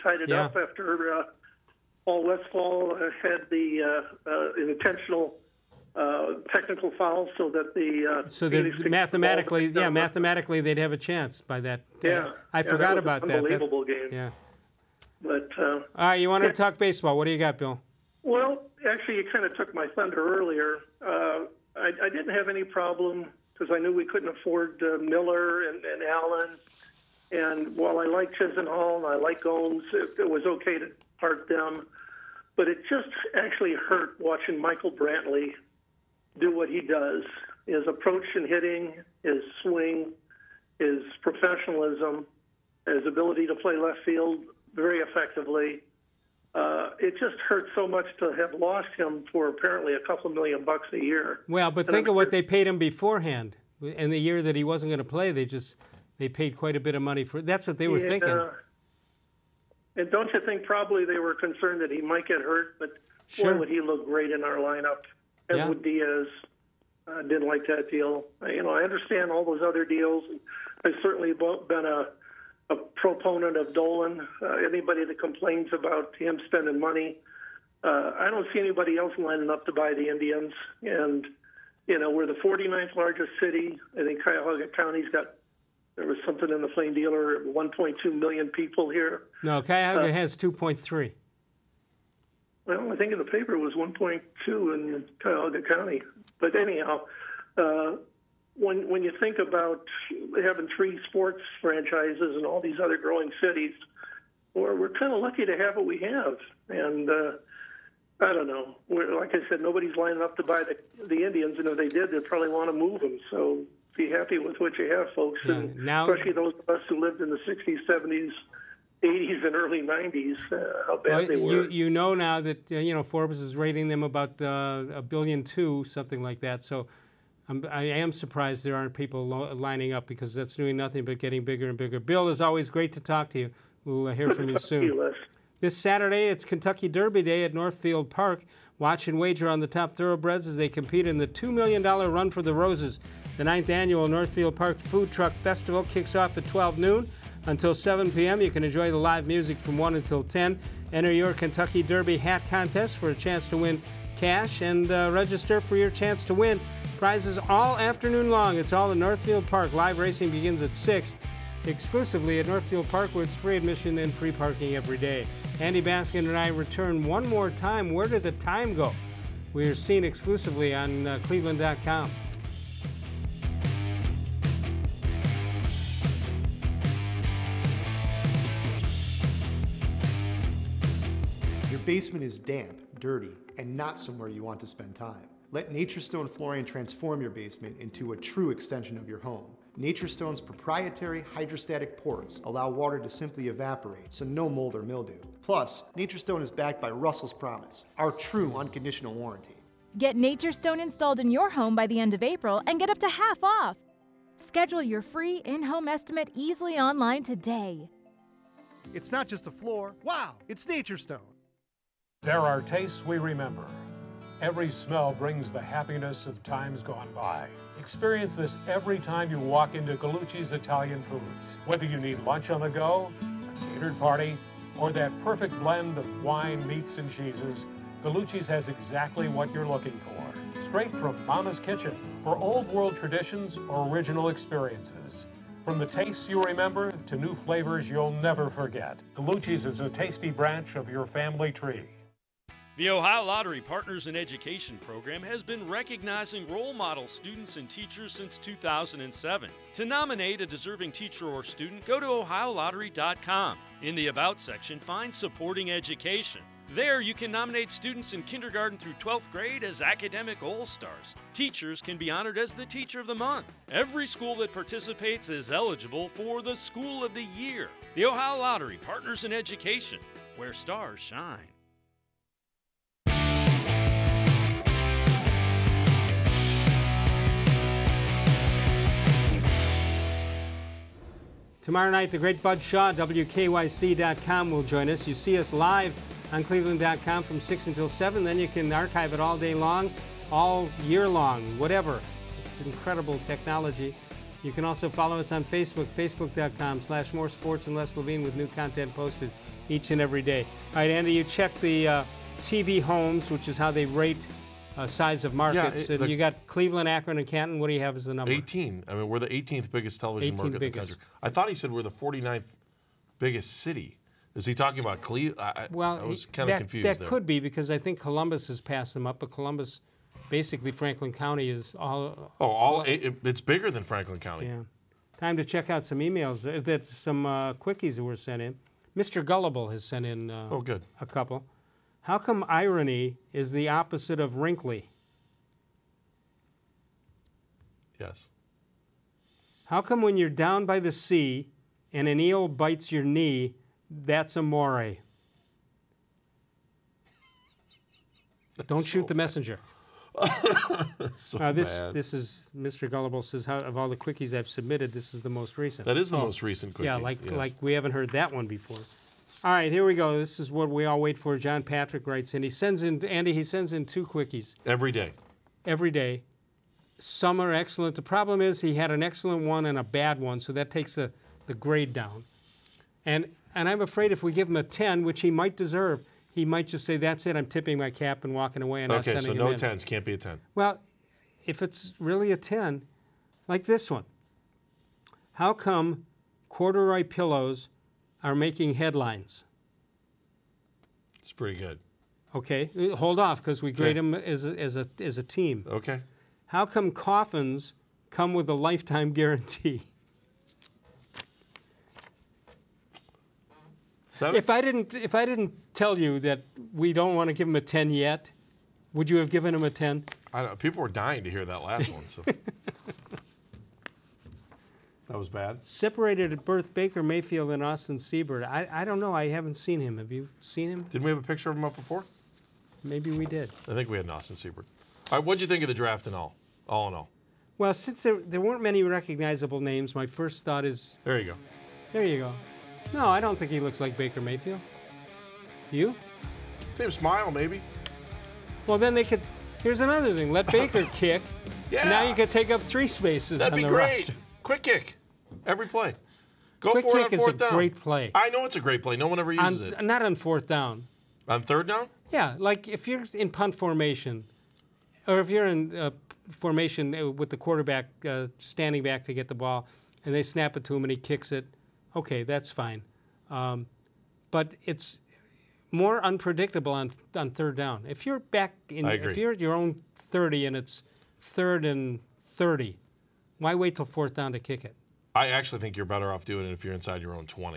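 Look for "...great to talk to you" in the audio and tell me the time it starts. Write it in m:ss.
2:12.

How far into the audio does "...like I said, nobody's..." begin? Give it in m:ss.
1:49.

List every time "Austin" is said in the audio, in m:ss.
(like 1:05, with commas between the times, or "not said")
6:57, 7:04.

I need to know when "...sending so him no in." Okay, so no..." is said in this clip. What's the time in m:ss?
6:19.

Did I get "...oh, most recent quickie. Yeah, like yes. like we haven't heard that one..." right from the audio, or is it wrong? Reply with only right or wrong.
right.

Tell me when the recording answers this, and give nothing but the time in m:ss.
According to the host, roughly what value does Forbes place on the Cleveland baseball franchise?
2:04.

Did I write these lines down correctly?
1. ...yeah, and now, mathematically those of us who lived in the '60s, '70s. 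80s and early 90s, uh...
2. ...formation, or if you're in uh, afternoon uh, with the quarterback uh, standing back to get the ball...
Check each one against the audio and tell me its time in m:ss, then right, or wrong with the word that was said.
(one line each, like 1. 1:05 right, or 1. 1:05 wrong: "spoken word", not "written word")
1. 1:55 wrong: "especially", not "mathematically"
2. 7:33 wrong: "formation", not "afternoon".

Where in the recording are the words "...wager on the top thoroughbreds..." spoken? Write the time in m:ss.
2:19.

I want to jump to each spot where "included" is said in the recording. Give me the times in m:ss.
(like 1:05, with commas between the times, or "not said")
not said.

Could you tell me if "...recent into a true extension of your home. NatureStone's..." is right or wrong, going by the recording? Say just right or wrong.
wrong.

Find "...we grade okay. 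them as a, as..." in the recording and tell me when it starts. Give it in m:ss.
6:33.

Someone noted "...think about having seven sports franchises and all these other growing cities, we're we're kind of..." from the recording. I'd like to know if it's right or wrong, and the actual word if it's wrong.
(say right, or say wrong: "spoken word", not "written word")
wrong: "three", not "seven".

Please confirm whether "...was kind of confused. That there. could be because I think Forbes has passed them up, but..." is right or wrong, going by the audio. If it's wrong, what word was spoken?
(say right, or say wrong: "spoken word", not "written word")
wrong: "Columbus", not "Forbes".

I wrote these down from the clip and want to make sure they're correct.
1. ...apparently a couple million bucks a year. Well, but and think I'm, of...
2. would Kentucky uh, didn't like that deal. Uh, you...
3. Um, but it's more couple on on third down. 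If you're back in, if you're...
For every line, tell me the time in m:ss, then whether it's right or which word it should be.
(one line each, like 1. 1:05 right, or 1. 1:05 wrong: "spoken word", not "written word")
1. 0:49 right
2. 1:05 wrong: "Diaz", not "Kentucky"
3. 7:43 wrong: "unpredictable", not "couple".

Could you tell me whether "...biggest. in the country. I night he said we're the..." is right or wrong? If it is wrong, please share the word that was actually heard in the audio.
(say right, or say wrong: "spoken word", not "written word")
wrong: "thought", not "night".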